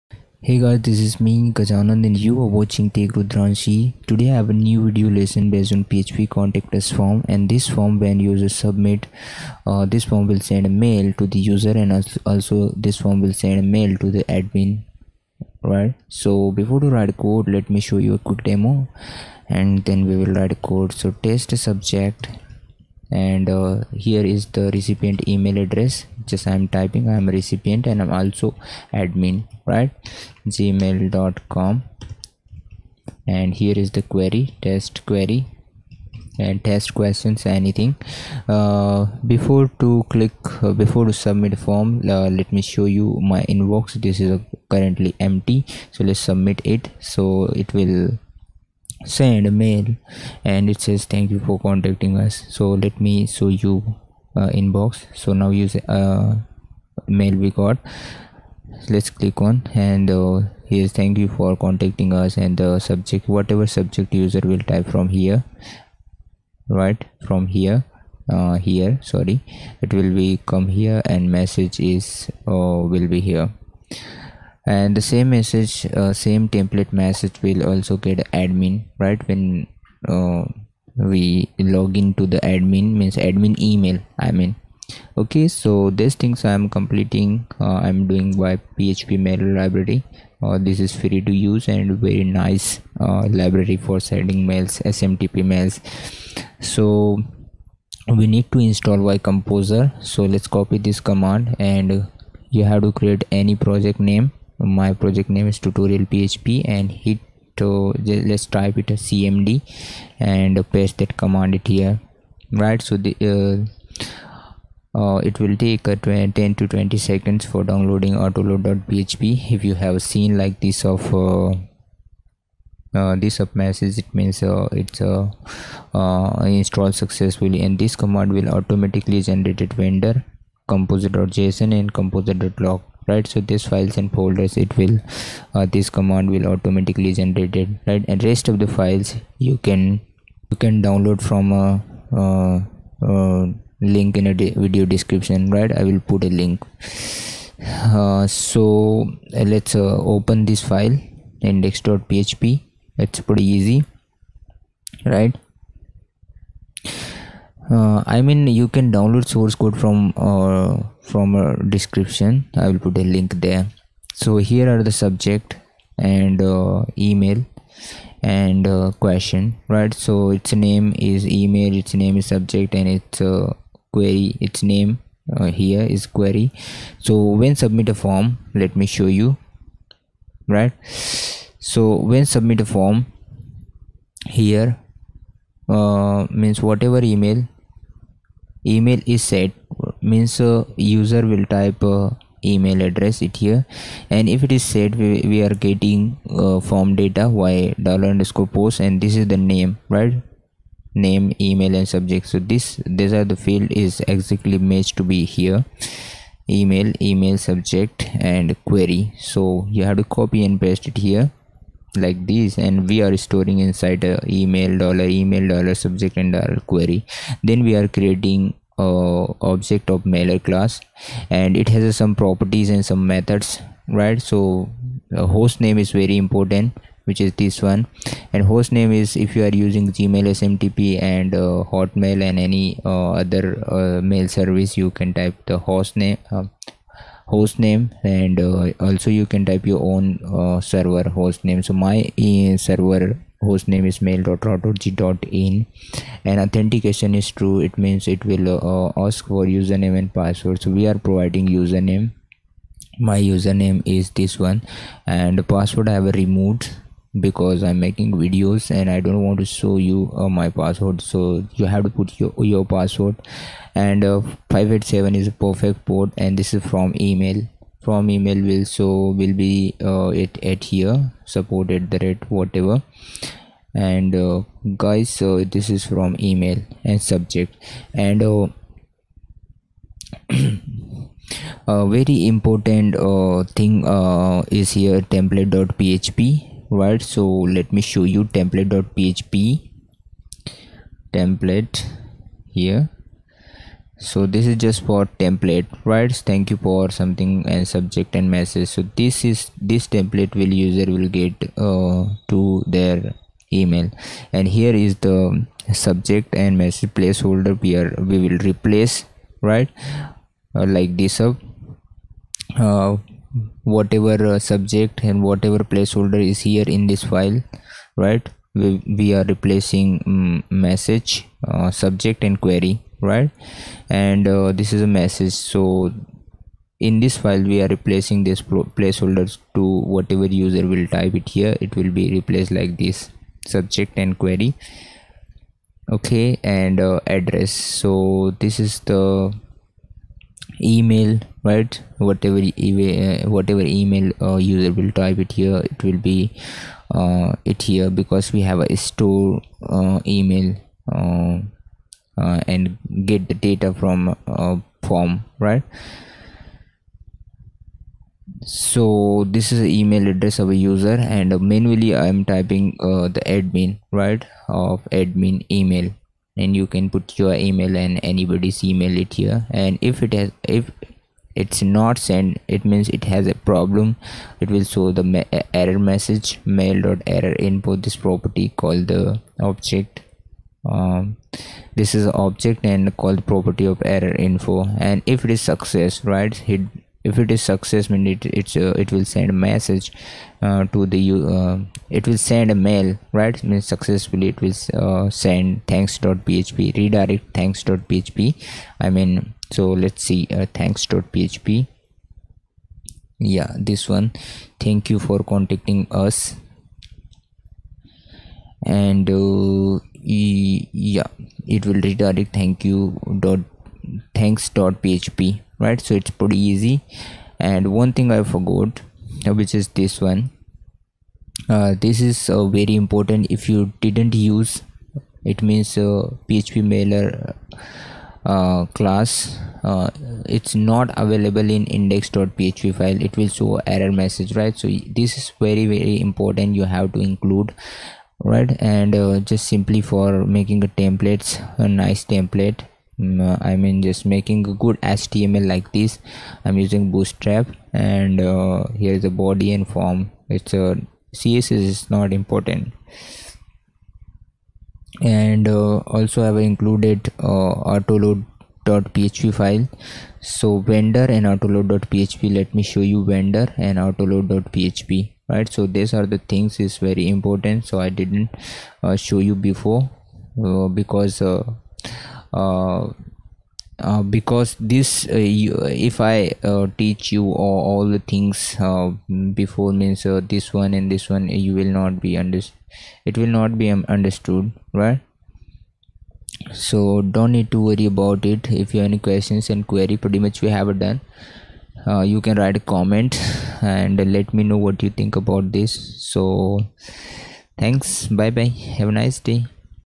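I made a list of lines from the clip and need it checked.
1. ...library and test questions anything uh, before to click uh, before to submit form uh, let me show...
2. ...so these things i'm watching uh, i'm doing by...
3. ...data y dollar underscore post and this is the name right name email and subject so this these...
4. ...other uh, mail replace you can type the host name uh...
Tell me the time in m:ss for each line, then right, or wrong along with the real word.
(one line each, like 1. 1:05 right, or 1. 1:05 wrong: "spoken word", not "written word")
1. 0:35 wrong: "query", not "library"
2. 1:25 wrong: "completing", not "watching"
3. 3:16 right
4. 3:53 wrong: "service", not "replace".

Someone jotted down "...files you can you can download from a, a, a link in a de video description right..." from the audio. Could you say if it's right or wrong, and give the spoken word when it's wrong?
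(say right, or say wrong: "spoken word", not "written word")
right.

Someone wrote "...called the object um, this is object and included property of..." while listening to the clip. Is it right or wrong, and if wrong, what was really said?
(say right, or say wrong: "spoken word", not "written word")
wrong: "called", not "included".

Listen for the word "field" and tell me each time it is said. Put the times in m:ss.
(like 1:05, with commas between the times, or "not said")
3:23.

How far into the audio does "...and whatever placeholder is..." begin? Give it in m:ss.
5:15.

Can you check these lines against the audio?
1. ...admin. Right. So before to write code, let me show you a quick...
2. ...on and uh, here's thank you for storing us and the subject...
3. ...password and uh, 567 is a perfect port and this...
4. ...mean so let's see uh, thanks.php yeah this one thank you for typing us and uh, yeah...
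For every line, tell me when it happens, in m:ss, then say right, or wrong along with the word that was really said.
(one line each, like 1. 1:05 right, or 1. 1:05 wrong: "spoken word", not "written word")
1. 0:14 right
2. 0:59 wrong: "contacting", not "storing"
3. 4:22 wrong: "587", not "567"
4. 6:38 wrong: "contacting", not "typing".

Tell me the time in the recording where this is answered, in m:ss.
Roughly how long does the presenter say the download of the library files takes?
1:55.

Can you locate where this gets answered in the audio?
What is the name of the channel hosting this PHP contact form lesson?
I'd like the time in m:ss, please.
0:02.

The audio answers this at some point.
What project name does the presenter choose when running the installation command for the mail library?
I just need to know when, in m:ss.
1:45.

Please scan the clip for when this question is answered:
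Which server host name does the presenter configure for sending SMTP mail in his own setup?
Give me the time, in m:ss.
4:04.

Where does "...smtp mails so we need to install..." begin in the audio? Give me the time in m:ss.
1:34.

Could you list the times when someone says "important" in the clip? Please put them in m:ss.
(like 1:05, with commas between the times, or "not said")
3:46, 4:42, 7:02, 7:16, 7:32, 7:47.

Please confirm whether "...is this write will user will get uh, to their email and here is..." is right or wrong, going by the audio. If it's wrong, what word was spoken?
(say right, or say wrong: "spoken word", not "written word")
wrong: "template", not "write".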